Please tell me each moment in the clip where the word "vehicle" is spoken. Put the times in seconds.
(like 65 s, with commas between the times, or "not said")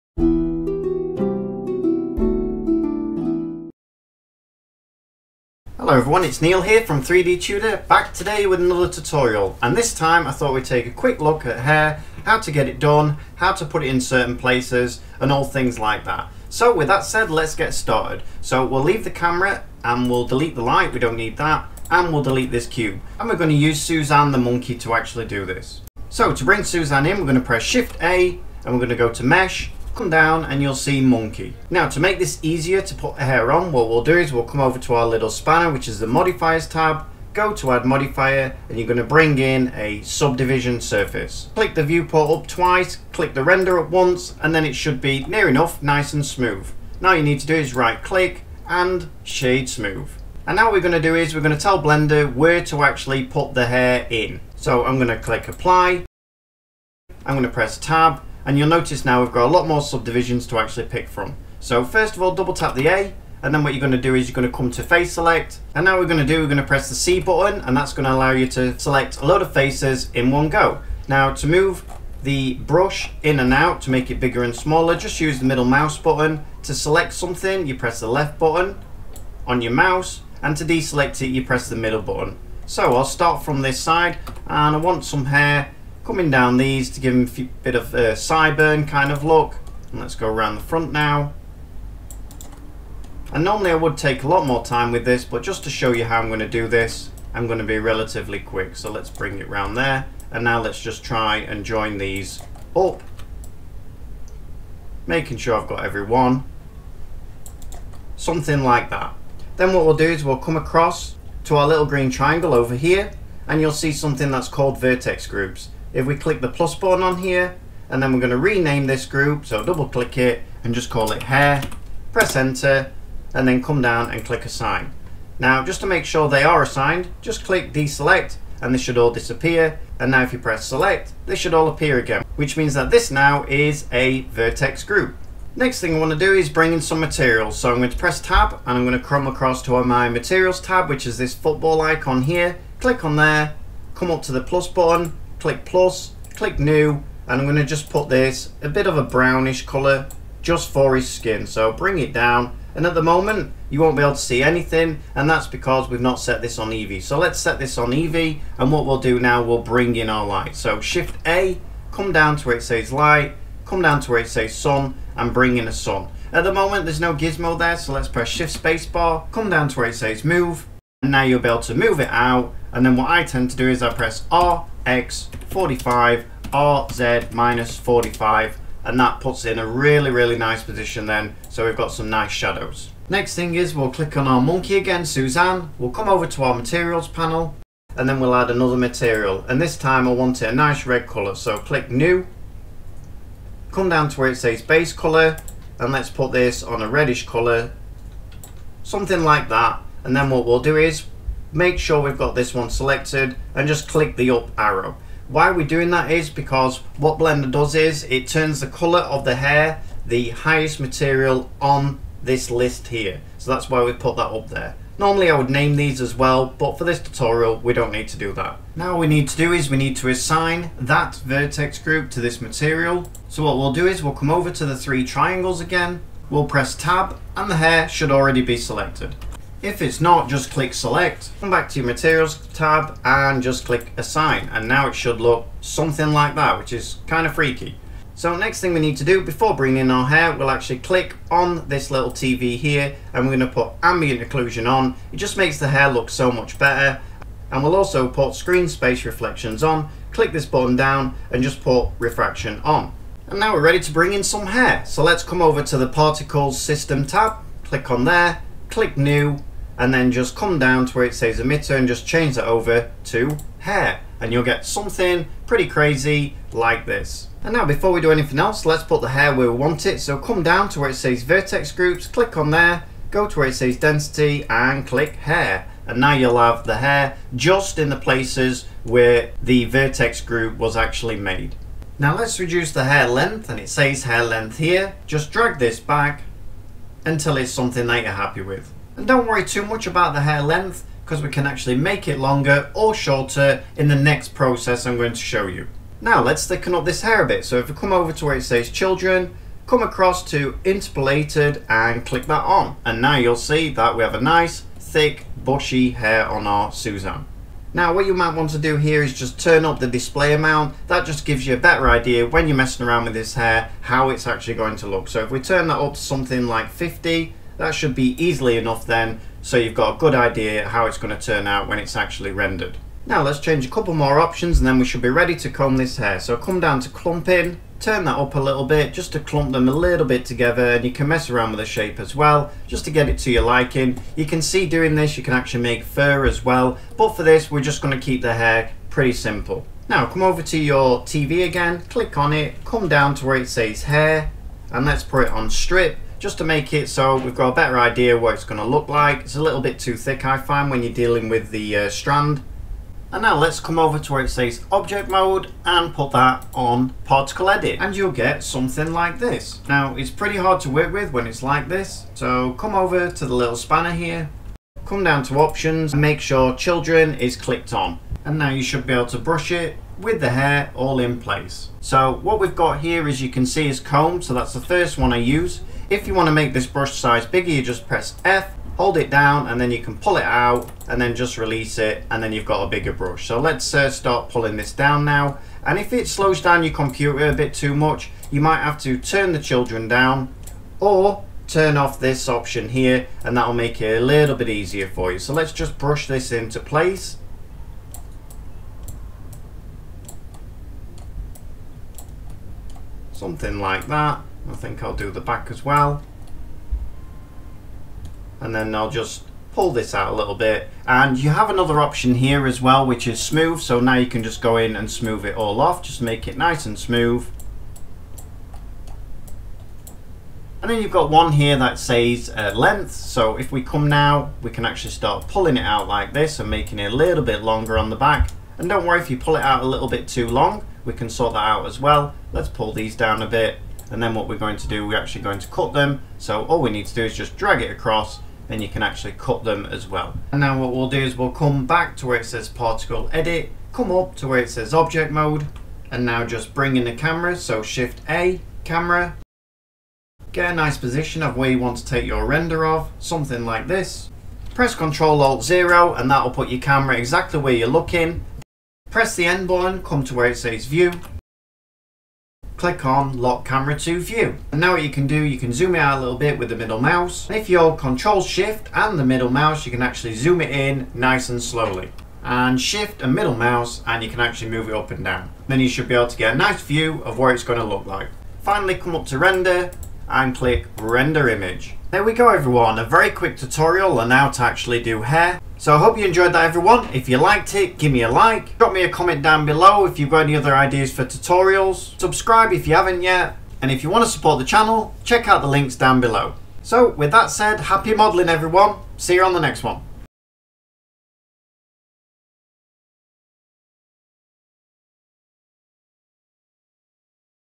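not said.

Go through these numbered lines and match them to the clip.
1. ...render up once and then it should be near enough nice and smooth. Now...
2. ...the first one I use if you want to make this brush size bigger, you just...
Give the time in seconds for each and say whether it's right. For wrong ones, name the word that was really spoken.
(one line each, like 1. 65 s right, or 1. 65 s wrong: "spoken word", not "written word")
1. 43 s right
2. 374 s right.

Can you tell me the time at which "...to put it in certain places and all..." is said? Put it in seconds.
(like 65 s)
13 s.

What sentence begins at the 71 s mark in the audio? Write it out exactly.
Now to move the brush in and out to make it bigger and smaller, just use the middle mouse button.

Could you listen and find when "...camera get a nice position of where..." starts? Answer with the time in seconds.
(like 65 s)
448 s.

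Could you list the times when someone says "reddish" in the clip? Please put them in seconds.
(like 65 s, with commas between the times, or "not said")
196 s.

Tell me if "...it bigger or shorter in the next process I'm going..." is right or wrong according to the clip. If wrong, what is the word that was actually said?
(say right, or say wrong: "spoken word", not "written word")
wrong: "longer", not "bigger".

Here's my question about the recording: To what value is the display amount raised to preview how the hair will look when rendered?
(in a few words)
50.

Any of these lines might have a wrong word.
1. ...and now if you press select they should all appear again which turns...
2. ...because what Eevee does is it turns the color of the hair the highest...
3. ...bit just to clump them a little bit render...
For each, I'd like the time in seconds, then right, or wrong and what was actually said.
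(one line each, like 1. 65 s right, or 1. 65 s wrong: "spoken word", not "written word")
1. 129 s wrong: "means", not "turns"
2. 206 s wrong: "Blender", not "Eevee"
3. 328 s wrong: "together", not "render".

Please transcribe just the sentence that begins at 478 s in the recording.
Finally come up to render and click render image.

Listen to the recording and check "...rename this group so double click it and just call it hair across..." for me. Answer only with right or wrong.
wrong.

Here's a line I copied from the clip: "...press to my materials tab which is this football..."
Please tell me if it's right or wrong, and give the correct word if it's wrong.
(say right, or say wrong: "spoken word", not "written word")
wrong: "across", not "press".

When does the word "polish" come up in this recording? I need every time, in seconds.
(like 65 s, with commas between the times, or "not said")
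not said.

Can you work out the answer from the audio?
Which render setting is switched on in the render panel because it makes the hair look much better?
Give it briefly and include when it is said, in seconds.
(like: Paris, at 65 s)
Ambient occlusion, at 243 s.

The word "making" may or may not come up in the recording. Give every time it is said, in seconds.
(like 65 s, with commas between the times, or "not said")
105 s, 426 s.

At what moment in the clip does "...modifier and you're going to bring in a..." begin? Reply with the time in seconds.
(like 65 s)
37 s.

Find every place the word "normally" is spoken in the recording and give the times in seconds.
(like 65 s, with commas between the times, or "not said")
93 s, 214 s.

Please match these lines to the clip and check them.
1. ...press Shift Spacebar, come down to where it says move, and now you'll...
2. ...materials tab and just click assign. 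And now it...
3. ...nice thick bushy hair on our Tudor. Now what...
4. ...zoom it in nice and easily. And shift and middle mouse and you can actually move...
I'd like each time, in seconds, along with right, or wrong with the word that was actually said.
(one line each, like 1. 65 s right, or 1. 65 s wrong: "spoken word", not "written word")
1. 168 s right
2. 231 s right
3. 304 s wrong: "Suzanne", not "Tudor"
4. 470 s wrong: "slowly", not "easily".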